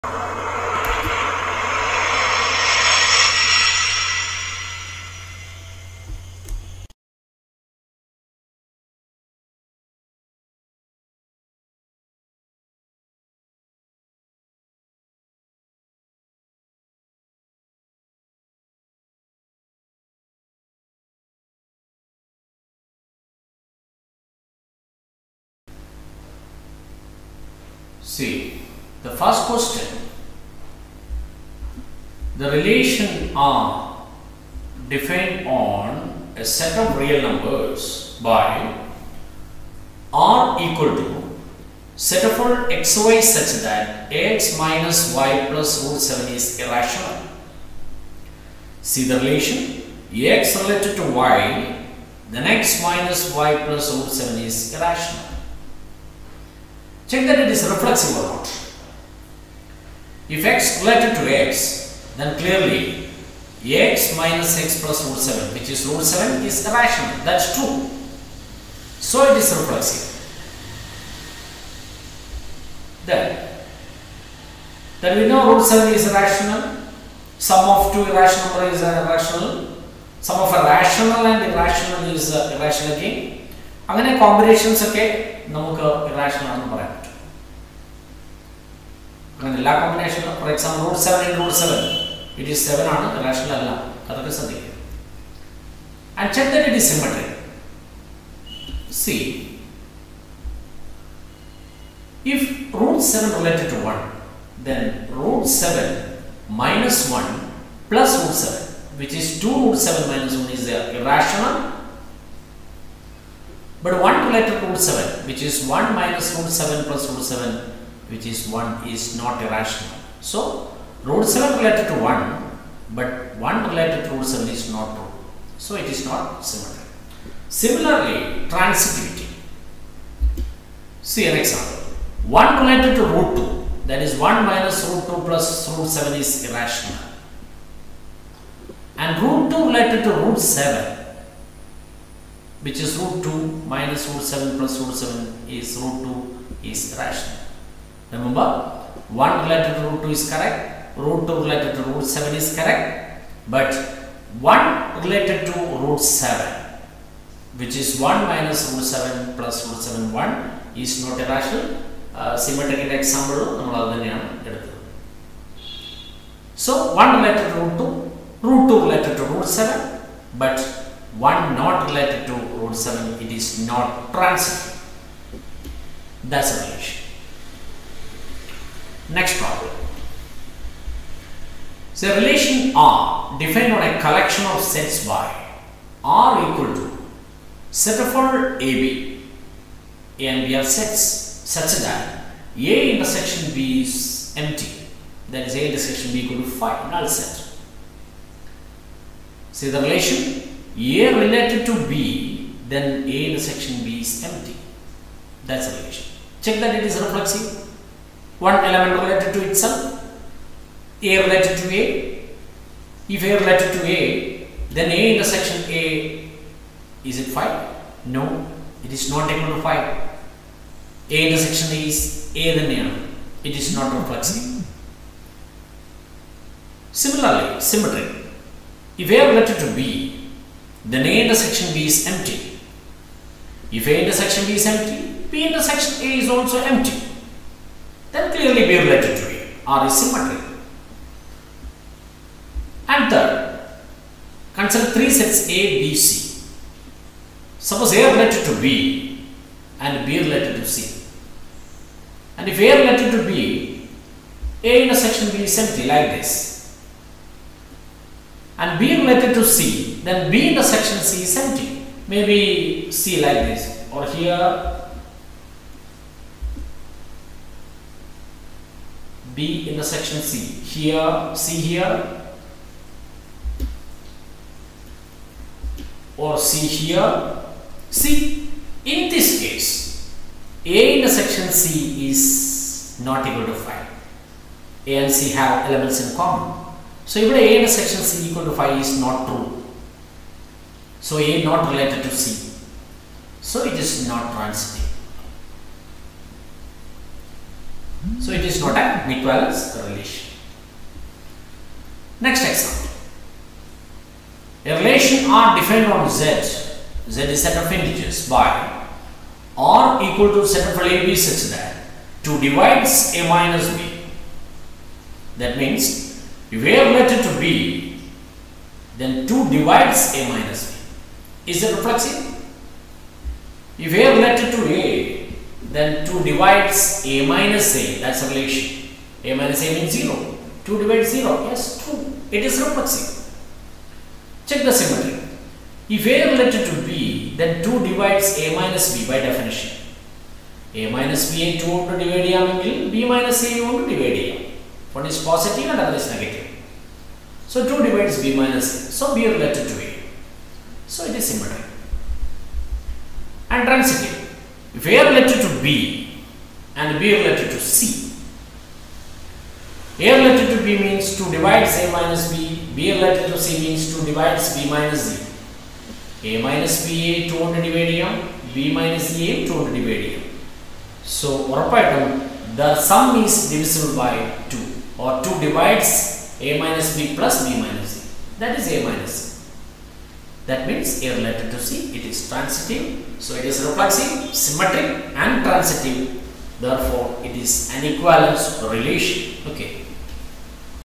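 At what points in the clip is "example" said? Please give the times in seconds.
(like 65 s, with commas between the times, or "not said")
131 s, 163 s, 302 s.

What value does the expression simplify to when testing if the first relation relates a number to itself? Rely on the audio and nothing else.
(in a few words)
root 7.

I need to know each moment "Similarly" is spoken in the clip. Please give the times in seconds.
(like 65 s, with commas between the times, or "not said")
127 s, 226 s.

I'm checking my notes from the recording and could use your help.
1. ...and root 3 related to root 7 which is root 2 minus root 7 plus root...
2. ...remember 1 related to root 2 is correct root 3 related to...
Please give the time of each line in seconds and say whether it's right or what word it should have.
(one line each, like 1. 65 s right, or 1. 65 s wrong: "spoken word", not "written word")
1. 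138 s wrong: "2", not "3"
2. 148 s wrong: "2", not "3".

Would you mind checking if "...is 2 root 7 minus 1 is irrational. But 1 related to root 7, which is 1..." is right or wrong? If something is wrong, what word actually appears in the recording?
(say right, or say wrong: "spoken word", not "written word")
right.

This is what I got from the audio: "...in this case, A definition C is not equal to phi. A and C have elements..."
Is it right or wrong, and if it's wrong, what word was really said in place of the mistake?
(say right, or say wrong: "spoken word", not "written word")
wrong: "intersection", not "definition".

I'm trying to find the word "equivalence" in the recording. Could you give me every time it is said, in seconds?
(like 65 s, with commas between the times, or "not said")
299 s, 387 s.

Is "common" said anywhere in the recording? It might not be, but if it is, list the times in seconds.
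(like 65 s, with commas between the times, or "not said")
286 s.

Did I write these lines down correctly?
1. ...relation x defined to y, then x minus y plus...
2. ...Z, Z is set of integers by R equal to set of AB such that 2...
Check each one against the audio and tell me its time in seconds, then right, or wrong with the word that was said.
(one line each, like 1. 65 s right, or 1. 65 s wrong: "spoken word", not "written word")
1. 49 s wrong: "related", not "defined"
2. 306 s right.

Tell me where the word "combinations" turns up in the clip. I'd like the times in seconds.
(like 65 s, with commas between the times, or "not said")
84 s.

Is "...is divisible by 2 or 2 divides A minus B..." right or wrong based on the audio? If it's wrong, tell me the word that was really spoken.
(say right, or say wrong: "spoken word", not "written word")
right.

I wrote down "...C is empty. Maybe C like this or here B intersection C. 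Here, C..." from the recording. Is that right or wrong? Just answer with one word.
right.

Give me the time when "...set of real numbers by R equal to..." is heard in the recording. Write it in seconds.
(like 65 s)
36 s.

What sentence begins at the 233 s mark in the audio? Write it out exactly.
If A intersection B is empty, B intersection A is also empty then clearly we to A or is symmetry.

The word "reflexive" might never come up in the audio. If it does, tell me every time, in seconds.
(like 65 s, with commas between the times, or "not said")
57 s, 69 s, 206 s, 223 s, 321 s, 332 s, 383 s.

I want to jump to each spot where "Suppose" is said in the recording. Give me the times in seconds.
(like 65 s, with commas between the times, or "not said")
247 s.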